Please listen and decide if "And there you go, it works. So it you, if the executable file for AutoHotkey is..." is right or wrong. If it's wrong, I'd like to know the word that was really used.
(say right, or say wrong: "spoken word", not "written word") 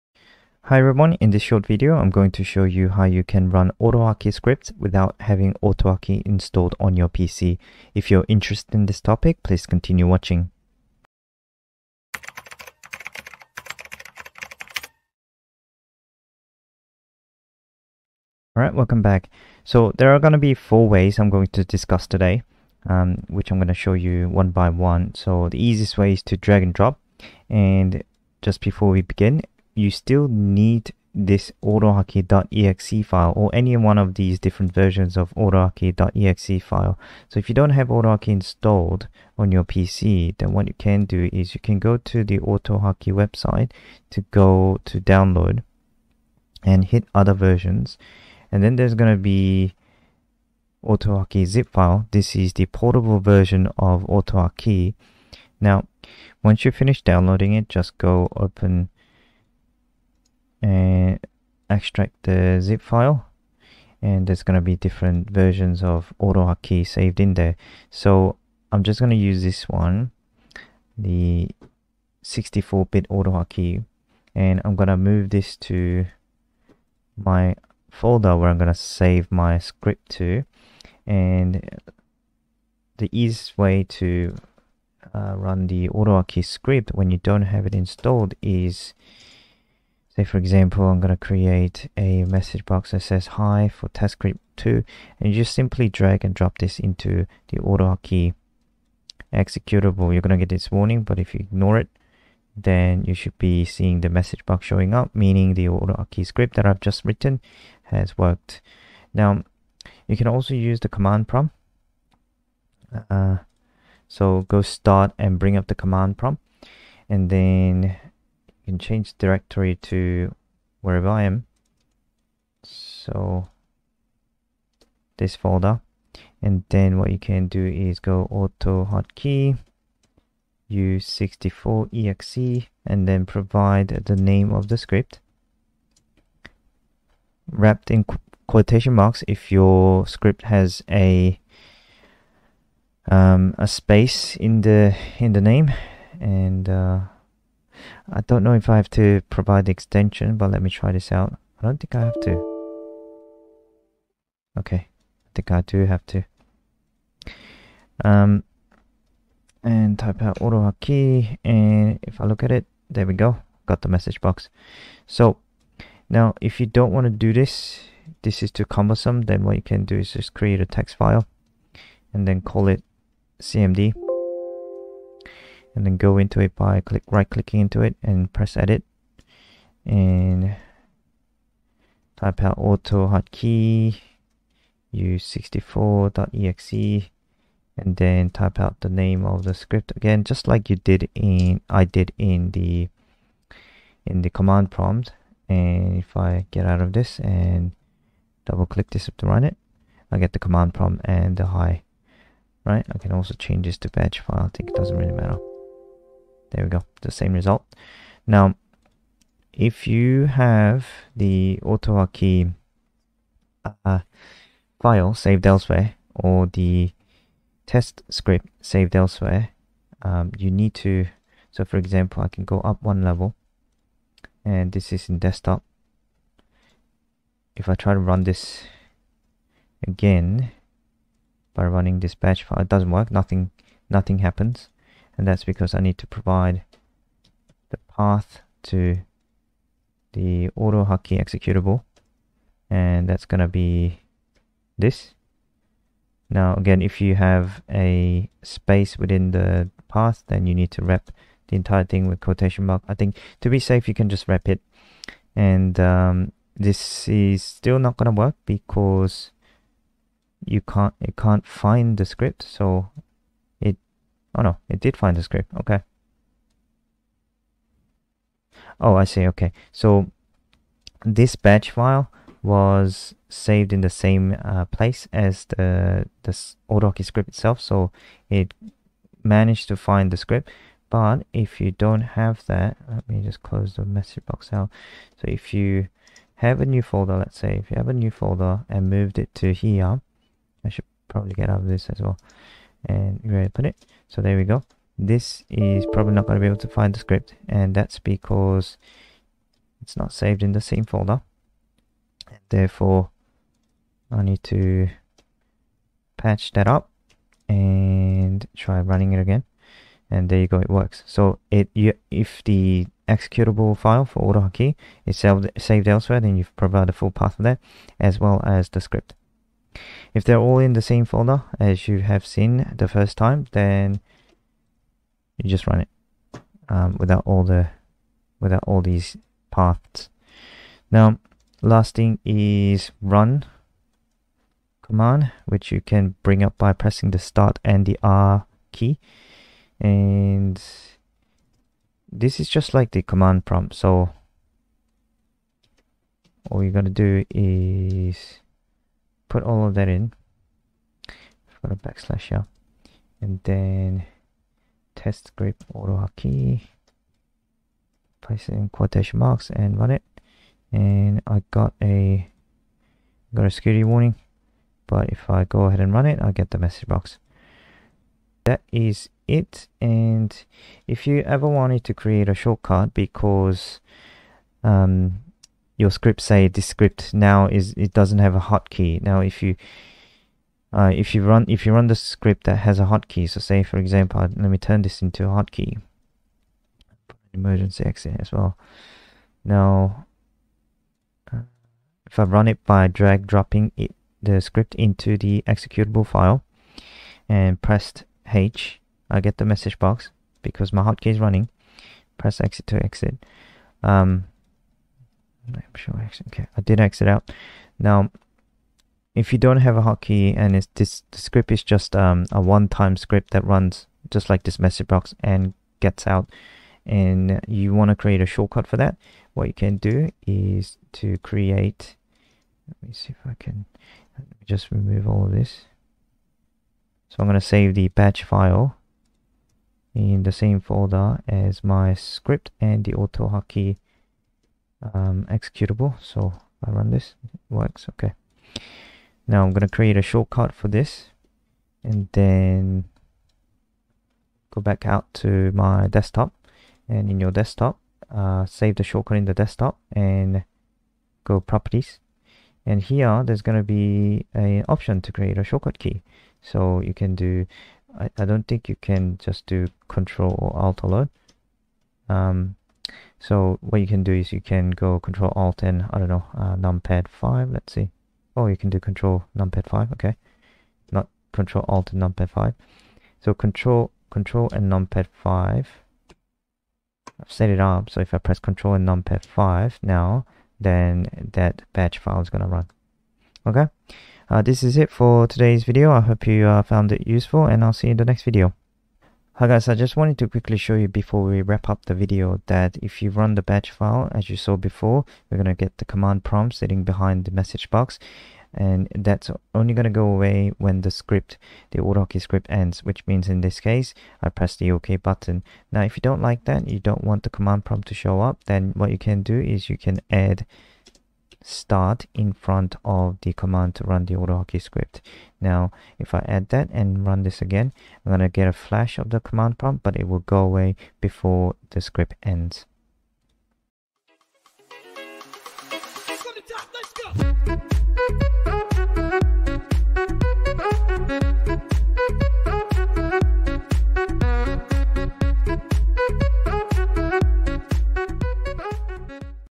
right.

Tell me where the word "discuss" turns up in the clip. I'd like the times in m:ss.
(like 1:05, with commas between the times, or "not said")
0:21.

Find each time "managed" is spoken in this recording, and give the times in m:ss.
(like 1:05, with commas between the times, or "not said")
4:39.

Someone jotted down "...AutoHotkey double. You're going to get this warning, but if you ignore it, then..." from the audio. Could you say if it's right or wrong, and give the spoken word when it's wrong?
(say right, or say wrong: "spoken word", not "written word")
wrong: "executable", not "double".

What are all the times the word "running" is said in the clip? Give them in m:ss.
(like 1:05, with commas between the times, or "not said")
3:51, 5:08, 6:41.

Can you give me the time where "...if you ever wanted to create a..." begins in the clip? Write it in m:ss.
6:10.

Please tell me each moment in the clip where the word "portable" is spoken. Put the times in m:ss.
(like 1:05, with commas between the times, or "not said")
0:52.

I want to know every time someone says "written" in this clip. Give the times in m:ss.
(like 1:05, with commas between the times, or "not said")
1:47.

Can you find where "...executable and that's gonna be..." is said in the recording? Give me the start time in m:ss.
4:00.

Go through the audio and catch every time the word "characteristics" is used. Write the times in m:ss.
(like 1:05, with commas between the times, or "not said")
not said.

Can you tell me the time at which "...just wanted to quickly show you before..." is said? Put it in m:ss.
8:09.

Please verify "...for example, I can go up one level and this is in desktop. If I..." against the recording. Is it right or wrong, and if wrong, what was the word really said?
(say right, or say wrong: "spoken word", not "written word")
right.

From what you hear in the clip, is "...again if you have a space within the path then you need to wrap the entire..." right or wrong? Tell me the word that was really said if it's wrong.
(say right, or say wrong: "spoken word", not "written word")
right.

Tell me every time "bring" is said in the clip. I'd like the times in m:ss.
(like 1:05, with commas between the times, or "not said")
1:55, 5:36.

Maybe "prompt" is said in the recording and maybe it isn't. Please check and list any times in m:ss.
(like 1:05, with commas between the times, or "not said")
1:51, 1:56, 3:14, 3:20, 5:43, 8:16, 8:27, 8:39.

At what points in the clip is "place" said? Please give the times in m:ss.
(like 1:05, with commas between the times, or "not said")
4:34, 5:58.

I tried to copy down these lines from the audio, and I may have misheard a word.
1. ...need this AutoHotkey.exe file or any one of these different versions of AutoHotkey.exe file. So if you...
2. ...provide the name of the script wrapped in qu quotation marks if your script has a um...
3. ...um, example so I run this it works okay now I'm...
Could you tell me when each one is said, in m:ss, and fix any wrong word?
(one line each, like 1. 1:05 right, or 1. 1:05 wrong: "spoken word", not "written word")
1. 0:30 right
2. 2:13 right
3. 7:14 wrong: "executable", not "example".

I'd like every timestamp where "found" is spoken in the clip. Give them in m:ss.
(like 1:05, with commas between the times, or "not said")
8:06.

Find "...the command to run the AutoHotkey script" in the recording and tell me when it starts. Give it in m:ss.
8:33.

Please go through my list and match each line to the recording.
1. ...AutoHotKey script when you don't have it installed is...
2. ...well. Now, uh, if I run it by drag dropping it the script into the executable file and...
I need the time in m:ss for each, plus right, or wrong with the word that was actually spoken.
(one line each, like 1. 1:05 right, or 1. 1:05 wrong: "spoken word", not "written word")
1. 1:25 right
2. 6:28 right.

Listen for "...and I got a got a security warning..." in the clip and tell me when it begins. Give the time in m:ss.
6:00.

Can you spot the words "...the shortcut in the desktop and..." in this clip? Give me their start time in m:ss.
7:28.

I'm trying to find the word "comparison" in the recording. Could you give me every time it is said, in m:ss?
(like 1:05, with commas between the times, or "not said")
not said.